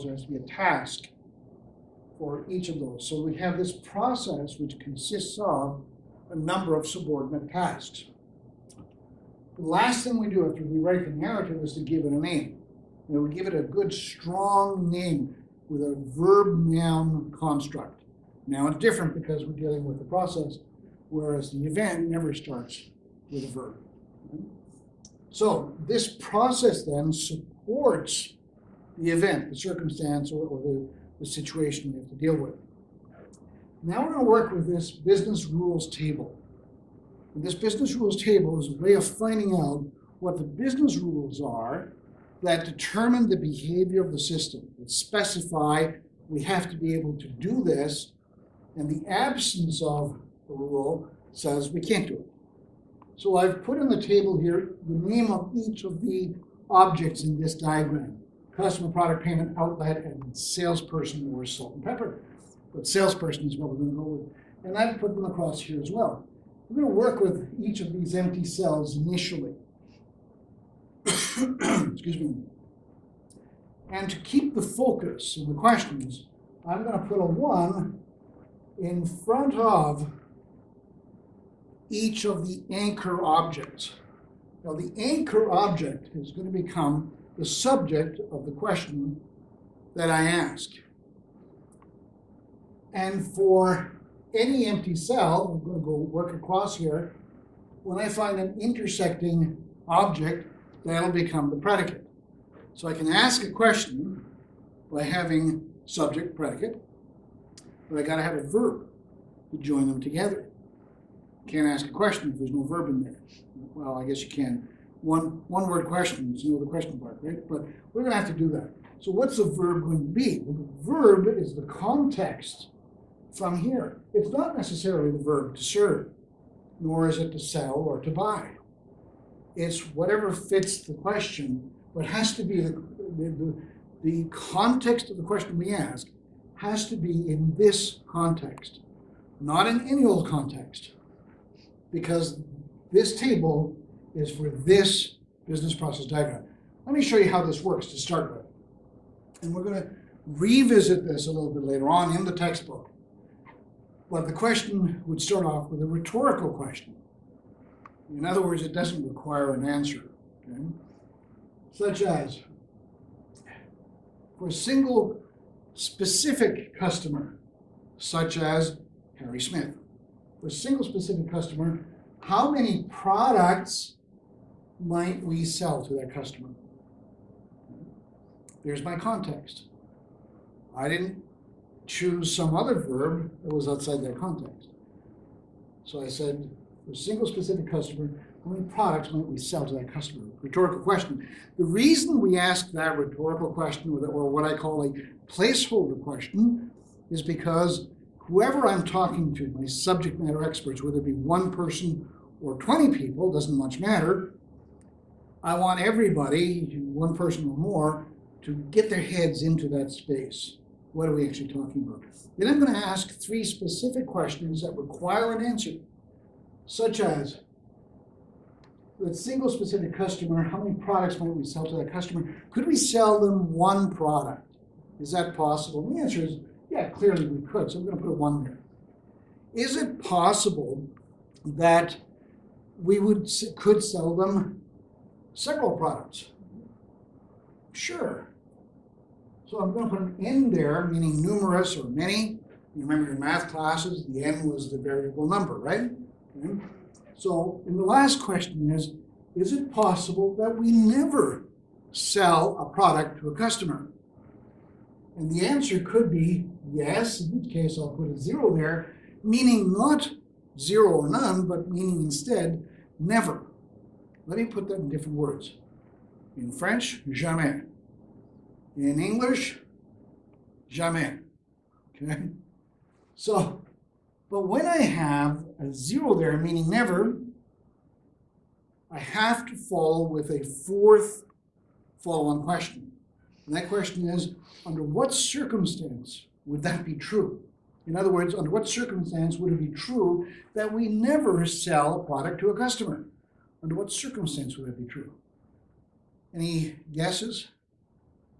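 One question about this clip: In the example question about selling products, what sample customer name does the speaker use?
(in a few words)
Harry Smith.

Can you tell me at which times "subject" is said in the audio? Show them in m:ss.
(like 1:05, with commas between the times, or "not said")
1:27, 1:45, 3:19.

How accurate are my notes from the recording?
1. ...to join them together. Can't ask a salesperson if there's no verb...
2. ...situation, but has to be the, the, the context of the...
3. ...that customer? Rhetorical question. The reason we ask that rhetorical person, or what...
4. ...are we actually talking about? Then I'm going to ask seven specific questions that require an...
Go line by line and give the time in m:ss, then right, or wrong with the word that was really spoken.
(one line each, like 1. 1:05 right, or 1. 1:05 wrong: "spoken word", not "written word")
1. 1:49 wrong: "question", not "salesperson"
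2. 2:10 wrong: "question", not "situation"
3. 3:09 wrong: "question", not "person"
4. 3:31 wrong: "three", not "seven".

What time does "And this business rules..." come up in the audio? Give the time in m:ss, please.
0:37.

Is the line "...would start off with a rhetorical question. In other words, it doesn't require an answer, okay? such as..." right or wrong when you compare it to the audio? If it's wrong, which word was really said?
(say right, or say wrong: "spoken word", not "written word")
right.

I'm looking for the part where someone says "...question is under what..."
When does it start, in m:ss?
4:43.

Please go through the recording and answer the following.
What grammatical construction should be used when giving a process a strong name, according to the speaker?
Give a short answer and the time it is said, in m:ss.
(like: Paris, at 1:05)
verb noun construct, at 0:16.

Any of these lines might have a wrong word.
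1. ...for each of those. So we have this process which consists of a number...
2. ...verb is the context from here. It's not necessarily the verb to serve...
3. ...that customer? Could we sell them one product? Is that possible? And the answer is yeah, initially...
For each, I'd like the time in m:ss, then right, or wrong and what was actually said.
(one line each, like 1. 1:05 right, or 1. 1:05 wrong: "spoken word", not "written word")
1. 0:02 right
2. 2:00 right
3. 3:41 wrong: "clearly", not "initially".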